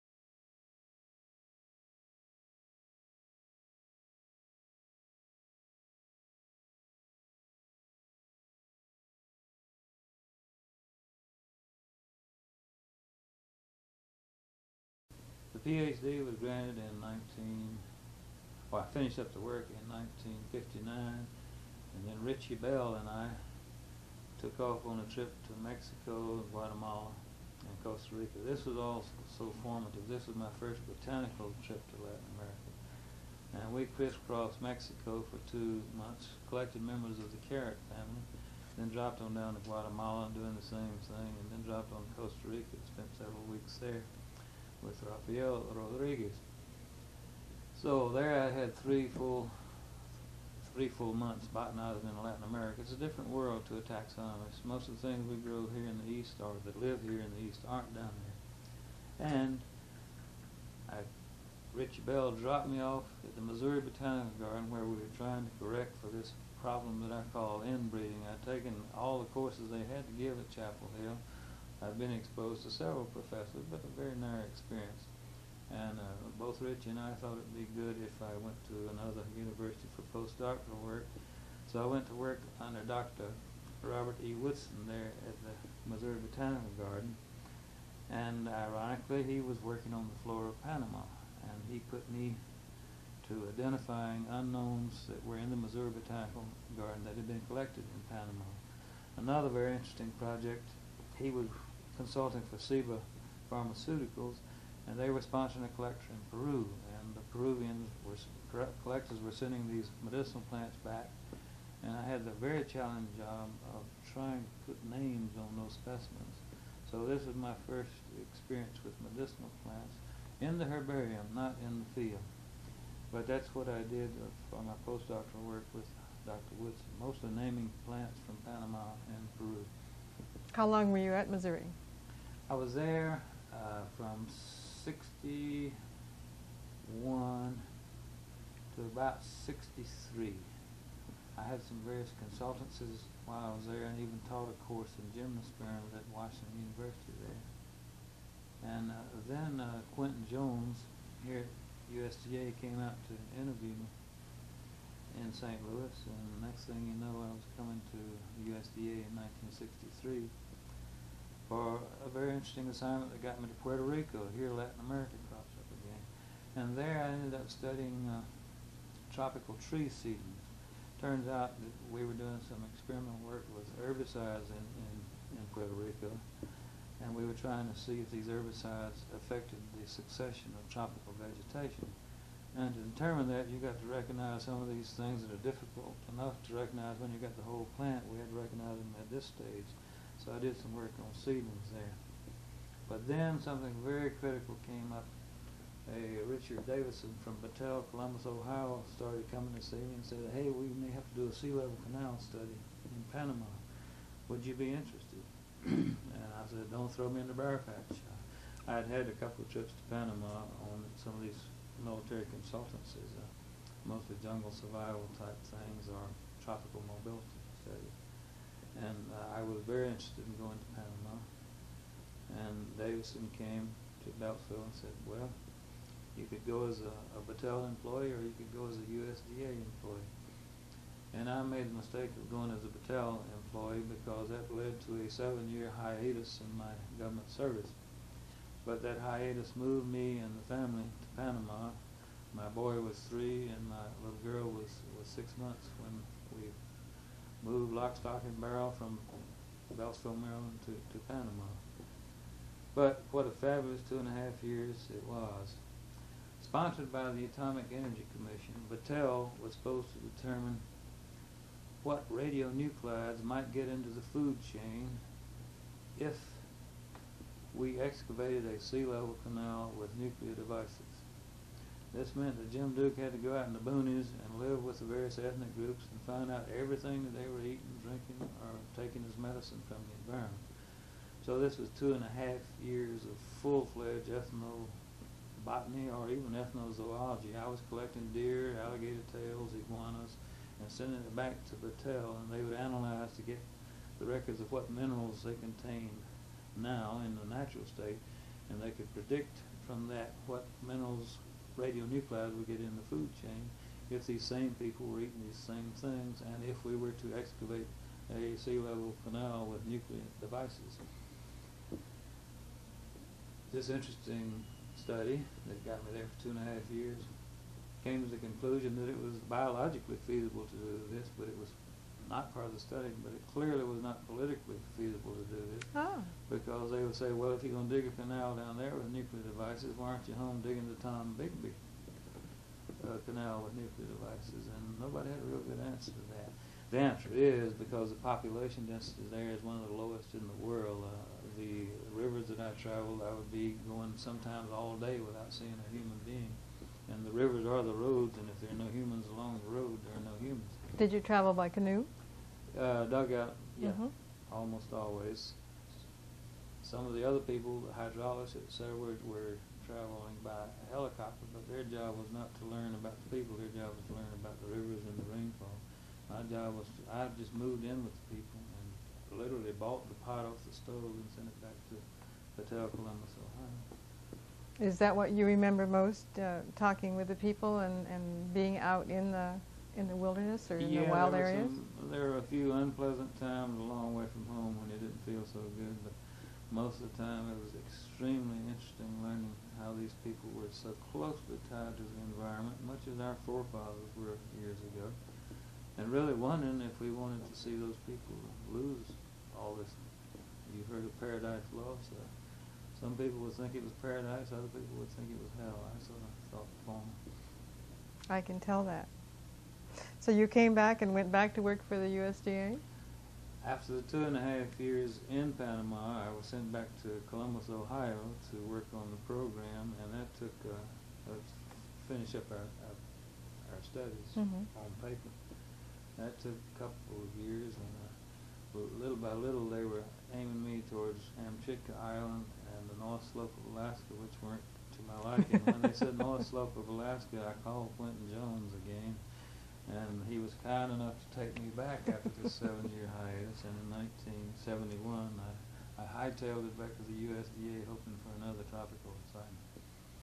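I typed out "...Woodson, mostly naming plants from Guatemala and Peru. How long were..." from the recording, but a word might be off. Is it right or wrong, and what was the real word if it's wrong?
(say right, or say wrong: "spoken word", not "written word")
wrong: "Panama", not "Guatemala".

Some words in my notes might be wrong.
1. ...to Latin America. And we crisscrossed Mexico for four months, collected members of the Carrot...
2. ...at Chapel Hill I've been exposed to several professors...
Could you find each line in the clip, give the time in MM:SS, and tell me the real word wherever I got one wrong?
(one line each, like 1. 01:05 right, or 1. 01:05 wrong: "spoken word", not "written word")
1. 00:31 wrong: "two", not "four"
2. 01:10 right.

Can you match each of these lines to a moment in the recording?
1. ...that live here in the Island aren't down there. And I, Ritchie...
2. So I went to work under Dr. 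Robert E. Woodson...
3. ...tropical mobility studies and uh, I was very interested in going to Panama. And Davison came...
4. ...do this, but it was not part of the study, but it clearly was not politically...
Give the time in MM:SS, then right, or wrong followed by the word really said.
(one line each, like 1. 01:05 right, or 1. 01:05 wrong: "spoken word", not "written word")
1. 00:56 wrong: "East", not "Island"
2. 01:21 right
3. 03:36 right
4. 05:20 right.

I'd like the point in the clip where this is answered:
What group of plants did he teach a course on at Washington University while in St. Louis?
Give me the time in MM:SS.
02:25.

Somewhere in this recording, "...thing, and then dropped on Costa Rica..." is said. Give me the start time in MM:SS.
00:41.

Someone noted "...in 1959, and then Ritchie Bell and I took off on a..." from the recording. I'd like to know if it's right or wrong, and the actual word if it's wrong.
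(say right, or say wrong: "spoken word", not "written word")
right.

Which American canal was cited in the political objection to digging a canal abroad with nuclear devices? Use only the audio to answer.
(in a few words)
Tombigbee.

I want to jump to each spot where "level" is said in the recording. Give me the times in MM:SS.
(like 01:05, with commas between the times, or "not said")
03:21, 04:28, 05:08.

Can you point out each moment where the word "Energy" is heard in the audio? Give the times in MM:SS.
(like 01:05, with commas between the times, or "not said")
04:17.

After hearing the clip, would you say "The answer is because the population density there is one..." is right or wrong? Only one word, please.
right.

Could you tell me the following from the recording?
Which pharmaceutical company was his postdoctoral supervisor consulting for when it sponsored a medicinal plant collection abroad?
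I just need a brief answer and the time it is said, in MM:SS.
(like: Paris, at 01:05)
Ciba Pharmaceuticals, at 01:42.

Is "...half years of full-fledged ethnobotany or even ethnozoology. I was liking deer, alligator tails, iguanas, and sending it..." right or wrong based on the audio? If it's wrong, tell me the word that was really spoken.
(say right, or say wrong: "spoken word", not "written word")
wrong: "collecting", not "liking".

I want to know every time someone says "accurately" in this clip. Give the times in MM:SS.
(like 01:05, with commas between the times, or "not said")
not said.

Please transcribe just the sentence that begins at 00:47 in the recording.
So there I had three full three full months botanizing in Latin America.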